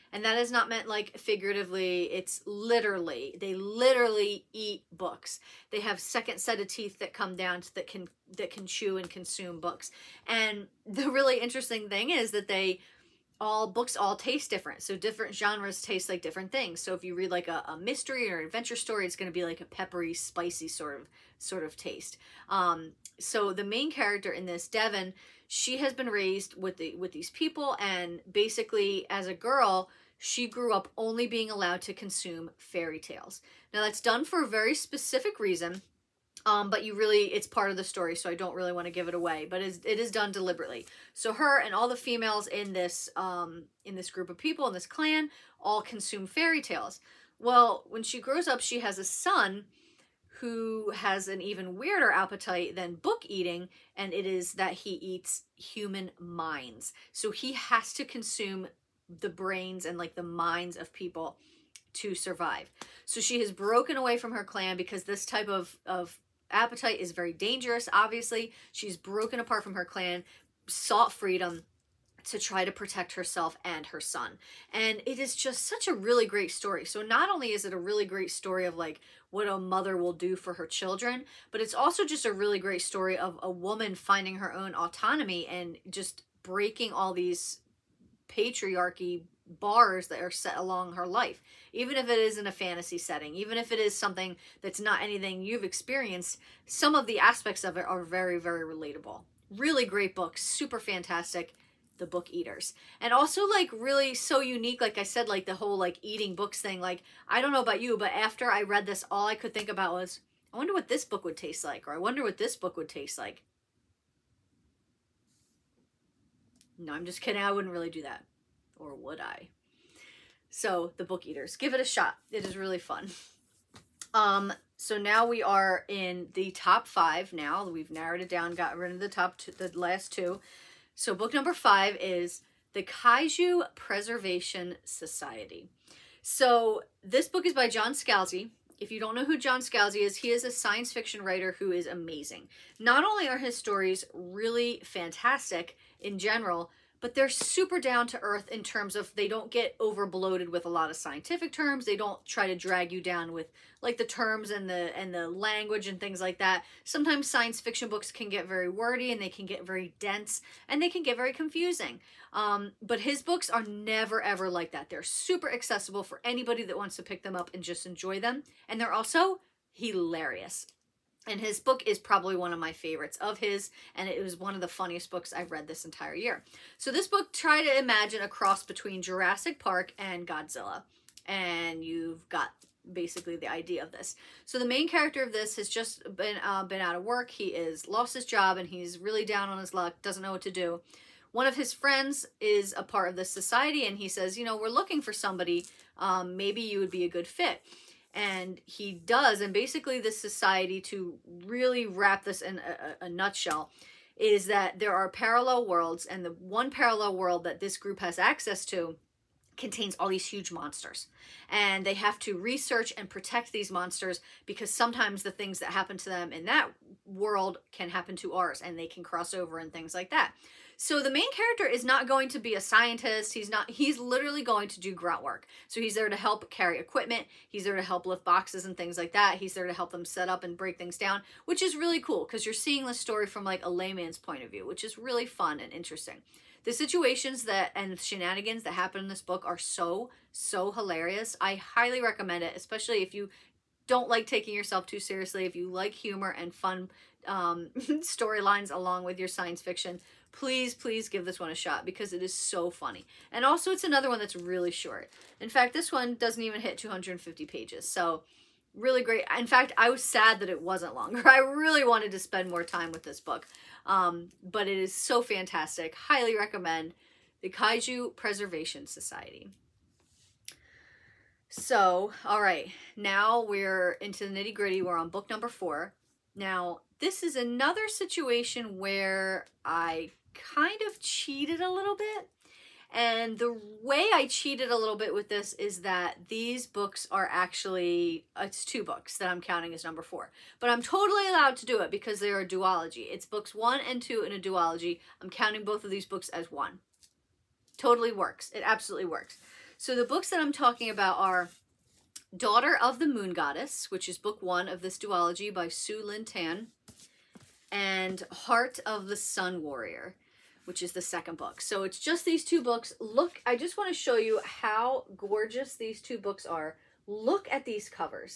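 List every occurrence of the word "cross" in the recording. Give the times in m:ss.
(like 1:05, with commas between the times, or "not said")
2:58, 3:39.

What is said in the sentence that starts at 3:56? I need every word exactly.
The situations that and shenanigans that happen in this book are so, so hilarious.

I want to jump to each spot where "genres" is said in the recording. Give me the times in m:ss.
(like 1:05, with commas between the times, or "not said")
0:15.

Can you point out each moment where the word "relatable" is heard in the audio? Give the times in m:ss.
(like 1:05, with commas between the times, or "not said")
1:38.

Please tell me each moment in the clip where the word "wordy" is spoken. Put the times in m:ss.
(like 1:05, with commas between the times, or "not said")
2:38.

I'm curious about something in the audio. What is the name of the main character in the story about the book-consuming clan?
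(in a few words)
Devin.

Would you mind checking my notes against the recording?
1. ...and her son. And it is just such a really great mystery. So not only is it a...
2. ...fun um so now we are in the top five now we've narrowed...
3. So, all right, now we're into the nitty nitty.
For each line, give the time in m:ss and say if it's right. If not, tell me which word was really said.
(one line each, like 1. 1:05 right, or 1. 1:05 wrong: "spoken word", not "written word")
1. 1:13 wrong: "story", not "mystery"
2. 2:02 right
3. 4:31 wrong: "gritty", not "nitty".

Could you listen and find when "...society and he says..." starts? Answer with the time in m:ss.
3:13.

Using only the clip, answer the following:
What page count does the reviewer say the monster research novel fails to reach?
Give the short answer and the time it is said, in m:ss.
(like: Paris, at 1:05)
250 pages, at 4:16.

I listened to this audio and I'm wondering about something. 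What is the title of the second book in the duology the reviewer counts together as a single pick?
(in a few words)
Heart of the Sun Warrior.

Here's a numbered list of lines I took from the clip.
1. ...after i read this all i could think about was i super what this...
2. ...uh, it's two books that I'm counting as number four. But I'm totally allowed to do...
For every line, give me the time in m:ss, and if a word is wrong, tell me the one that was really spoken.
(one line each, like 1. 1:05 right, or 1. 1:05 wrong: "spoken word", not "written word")
1. 1:48 wrong: "wonder", not "super"
2. 4:48 right.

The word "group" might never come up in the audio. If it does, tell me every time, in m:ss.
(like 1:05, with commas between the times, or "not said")
0:44, 3:27.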